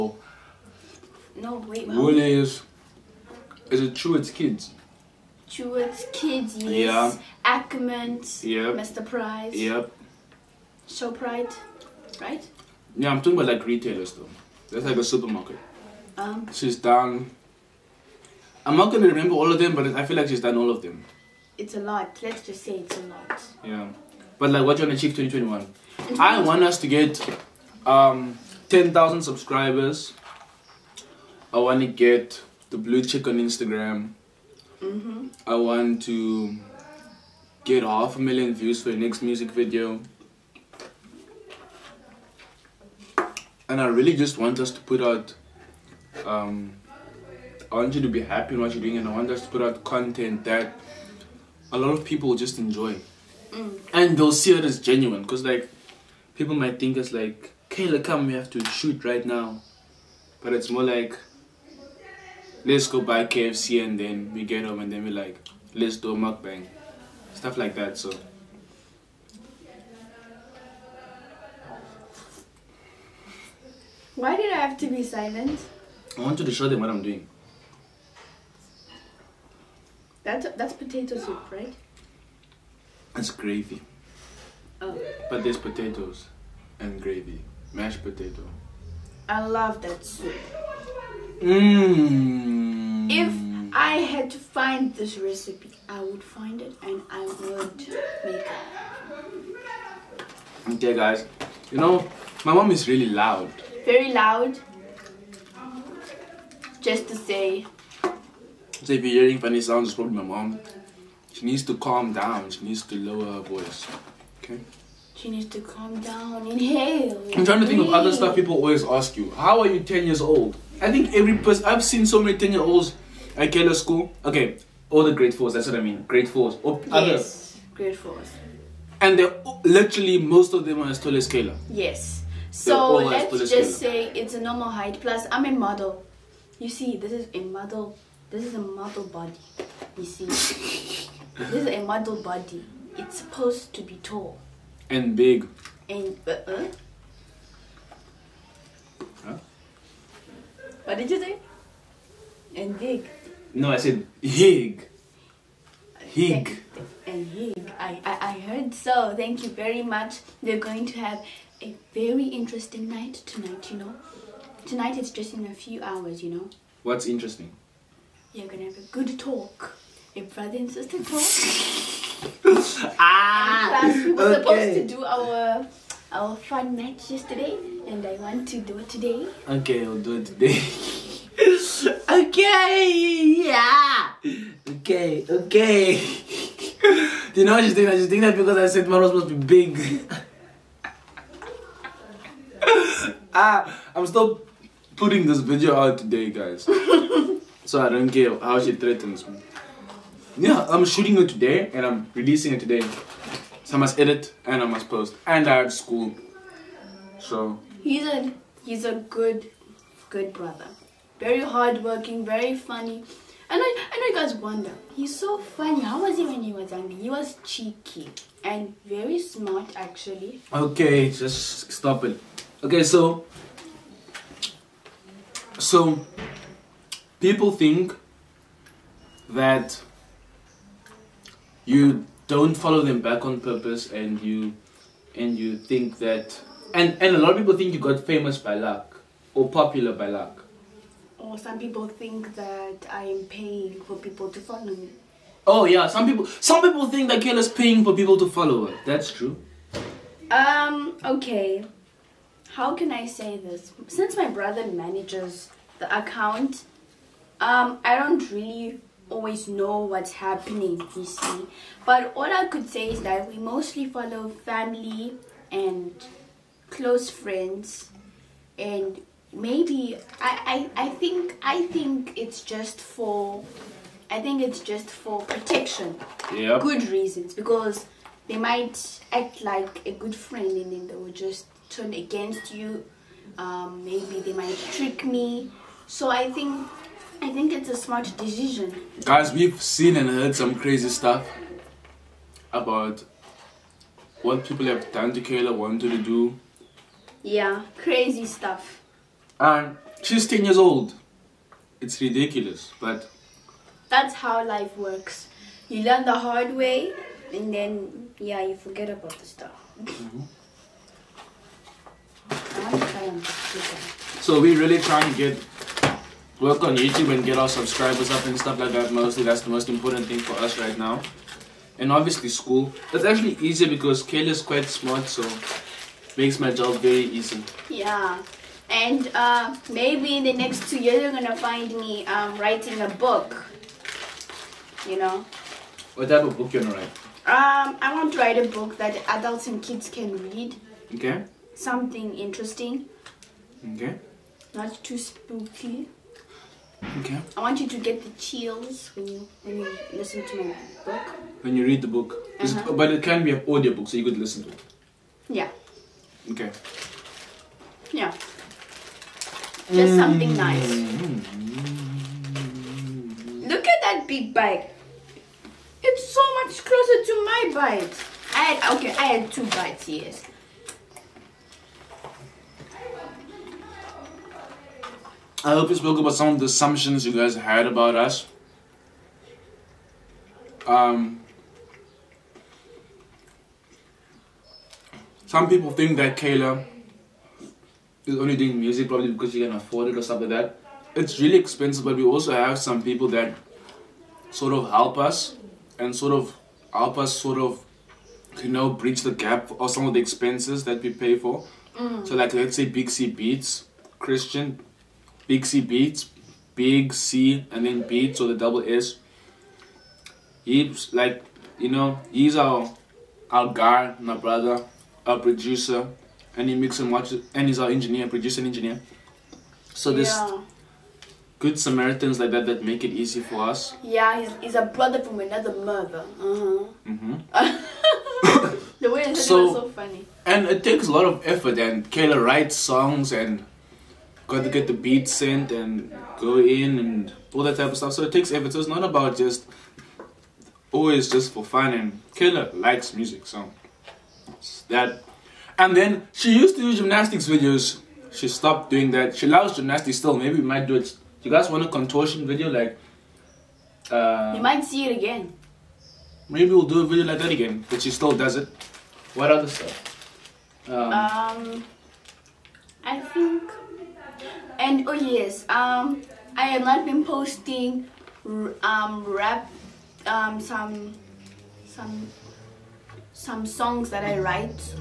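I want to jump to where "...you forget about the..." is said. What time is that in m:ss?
5:08.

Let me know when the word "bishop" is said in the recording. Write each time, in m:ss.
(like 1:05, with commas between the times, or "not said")
not said.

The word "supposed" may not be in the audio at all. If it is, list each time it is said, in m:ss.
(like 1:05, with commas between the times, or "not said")
2:23, 2:54, 3:09.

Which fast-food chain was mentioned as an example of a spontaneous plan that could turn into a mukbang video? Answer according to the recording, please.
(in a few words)
KFC.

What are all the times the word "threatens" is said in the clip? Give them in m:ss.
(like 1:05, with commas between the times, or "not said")
3:18.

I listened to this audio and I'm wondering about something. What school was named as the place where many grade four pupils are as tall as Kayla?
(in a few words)
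Keller School.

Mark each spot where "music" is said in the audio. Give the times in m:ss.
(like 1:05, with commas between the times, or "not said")
0:39, 6:28, 7:22.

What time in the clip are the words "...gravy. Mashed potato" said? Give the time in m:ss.
1:27.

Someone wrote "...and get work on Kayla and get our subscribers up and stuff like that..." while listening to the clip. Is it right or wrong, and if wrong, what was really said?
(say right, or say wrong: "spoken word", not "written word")
wrong: "YouTube", not "Kayla".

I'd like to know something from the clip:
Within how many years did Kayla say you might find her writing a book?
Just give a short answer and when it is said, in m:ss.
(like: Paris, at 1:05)
2, at 5:30.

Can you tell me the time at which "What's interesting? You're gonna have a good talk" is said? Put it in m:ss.
2:46.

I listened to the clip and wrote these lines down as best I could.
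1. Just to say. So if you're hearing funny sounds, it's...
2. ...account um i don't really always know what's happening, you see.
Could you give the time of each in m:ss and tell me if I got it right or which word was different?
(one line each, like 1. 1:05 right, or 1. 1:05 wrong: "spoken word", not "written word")
1. 1:46 right
2. 4:16 right.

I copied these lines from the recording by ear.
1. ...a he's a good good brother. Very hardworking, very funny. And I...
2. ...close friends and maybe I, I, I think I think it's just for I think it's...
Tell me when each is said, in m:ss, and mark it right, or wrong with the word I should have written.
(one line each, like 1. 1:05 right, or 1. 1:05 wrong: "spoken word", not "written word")
1. 3:28 right
2. 4:26 right.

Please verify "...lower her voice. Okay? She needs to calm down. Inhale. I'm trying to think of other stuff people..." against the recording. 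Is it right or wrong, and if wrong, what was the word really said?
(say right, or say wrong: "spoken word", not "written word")
right.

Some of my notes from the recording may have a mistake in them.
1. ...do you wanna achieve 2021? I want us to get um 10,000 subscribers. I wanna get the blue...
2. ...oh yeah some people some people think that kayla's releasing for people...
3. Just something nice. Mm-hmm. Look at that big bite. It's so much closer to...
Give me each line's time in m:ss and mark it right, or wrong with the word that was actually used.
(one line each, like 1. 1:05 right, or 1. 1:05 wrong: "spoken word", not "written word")
1. 0:24 right
2. 4:05 wrong: "paying", not "releasing"
3. 5:59 right.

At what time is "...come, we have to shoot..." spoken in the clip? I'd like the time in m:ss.
0:58.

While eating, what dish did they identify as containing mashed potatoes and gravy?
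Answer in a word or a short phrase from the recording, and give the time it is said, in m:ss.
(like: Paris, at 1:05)
potato soup, at 1:20.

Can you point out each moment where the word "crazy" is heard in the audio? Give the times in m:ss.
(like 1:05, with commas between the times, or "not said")
4:50, 4:57.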